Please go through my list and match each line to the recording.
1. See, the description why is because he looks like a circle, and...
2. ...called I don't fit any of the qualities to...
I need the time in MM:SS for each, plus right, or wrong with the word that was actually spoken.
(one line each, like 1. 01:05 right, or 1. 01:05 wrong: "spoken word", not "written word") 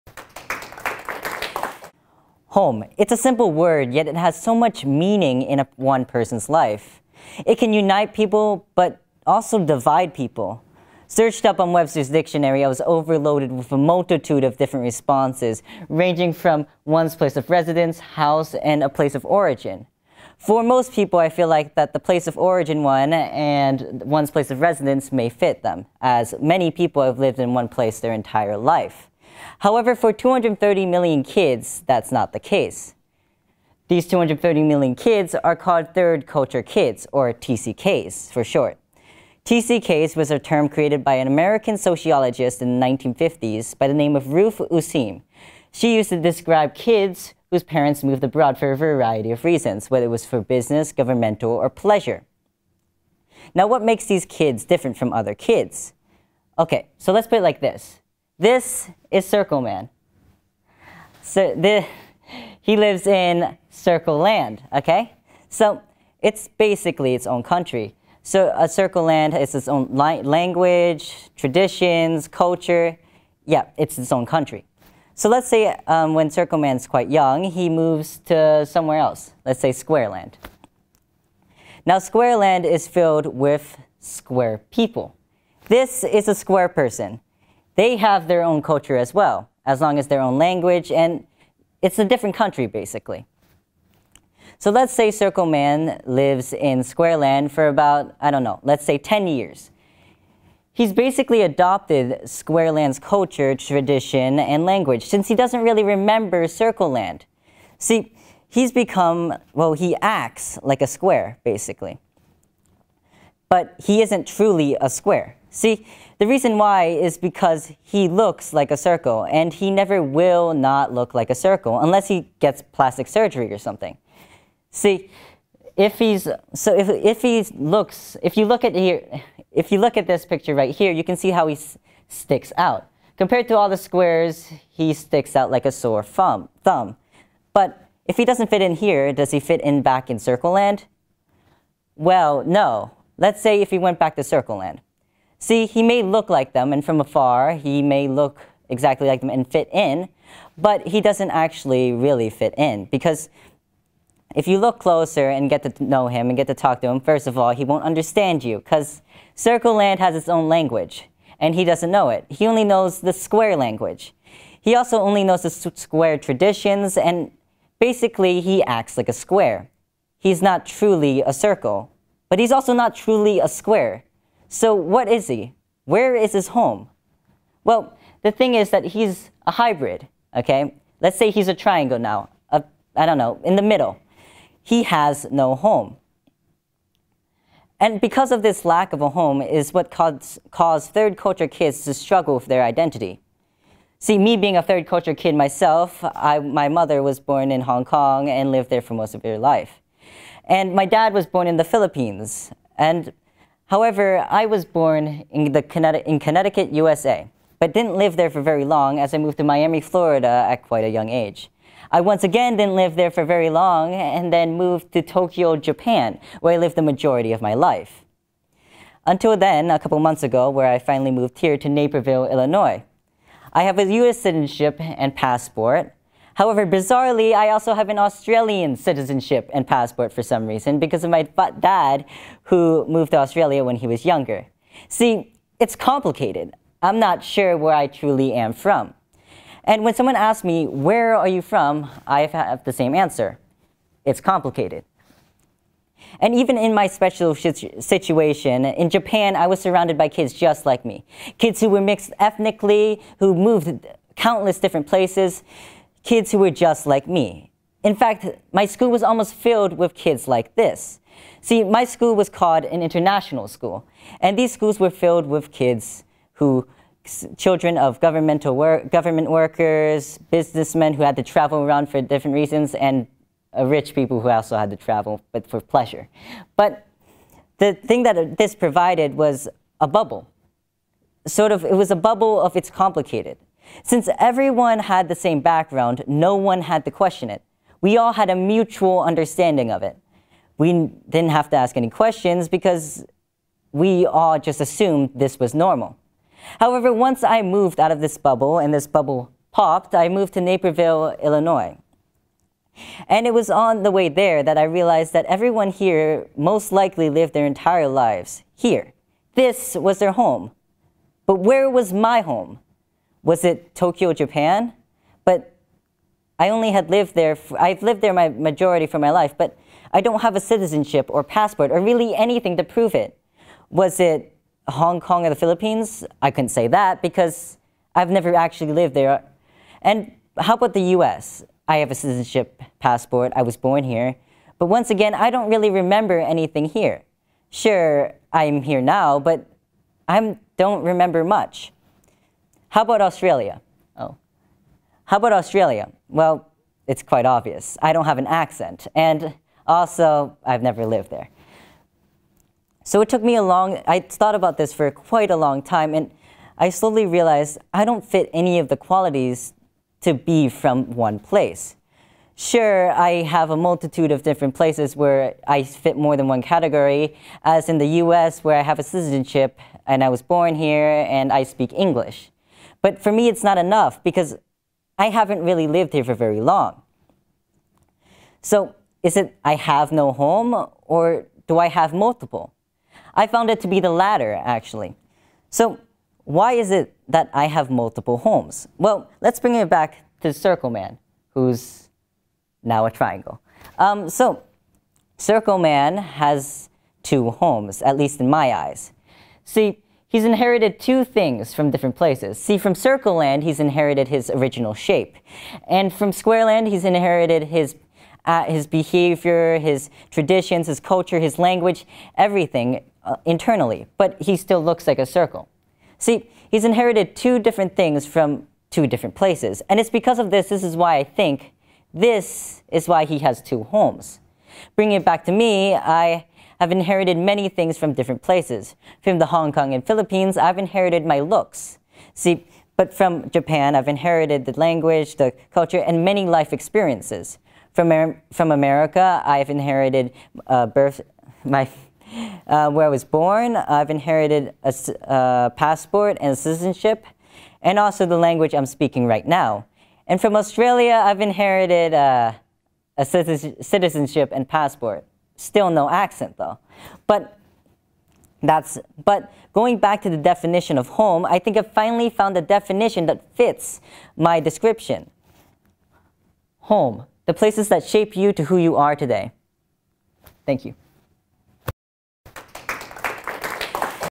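1. 01:55 wrong: "reason", not "description"
2. 05:57 wrong: "realized", not "called".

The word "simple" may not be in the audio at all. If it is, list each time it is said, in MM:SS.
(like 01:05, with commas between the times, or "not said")
00:03.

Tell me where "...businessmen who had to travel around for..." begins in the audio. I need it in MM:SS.
04:30.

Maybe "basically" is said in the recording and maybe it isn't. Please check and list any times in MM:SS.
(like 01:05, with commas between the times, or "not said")
01:06, 01:32, 01:40, 01:51, 02:47.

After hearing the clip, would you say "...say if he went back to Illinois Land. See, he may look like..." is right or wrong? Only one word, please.
wrong.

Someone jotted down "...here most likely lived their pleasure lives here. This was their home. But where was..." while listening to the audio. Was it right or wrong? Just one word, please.
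wrong.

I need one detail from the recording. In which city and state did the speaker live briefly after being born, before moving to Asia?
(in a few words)
Miami, Florida.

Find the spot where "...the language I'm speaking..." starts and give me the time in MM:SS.
07:28.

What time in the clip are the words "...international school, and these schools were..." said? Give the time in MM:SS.
04:22.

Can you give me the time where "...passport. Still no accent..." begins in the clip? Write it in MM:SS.
07:34.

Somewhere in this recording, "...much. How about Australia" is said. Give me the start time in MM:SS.
05:41.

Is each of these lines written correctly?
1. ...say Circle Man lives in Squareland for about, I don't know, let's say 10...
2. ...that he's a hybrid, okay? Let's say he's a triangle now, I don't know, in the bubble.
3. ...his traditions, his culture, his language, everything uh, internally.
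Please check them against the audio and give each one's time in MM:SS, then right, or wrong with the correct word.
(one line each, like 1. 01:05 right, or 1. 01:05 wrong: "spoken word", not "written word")
1. 01:34 right
2. 02:58 wrong: "middle", not "bubble"
3. 06:49 right.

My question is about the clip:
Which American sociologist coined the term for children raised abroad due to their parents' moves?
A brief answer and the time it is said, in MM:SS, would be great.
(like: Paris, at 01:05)
Ruth Useem, at 00:44.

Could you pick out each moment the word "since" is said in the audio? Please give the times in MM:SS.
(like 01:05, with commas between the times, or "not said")
01:45, 04:43.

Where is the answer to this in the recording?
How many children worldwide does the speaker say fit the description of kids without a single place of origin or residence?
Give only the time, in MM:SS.
00:34.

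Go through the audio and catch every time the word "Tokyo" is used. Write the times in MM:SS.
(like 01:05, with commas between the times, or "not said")
03:35, 05:13.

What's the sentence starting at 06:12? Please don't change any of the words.
But for me, it's not enough because I haven't really lived here for very long.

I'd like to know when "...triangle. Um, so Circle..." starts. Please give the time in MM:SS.
06:32.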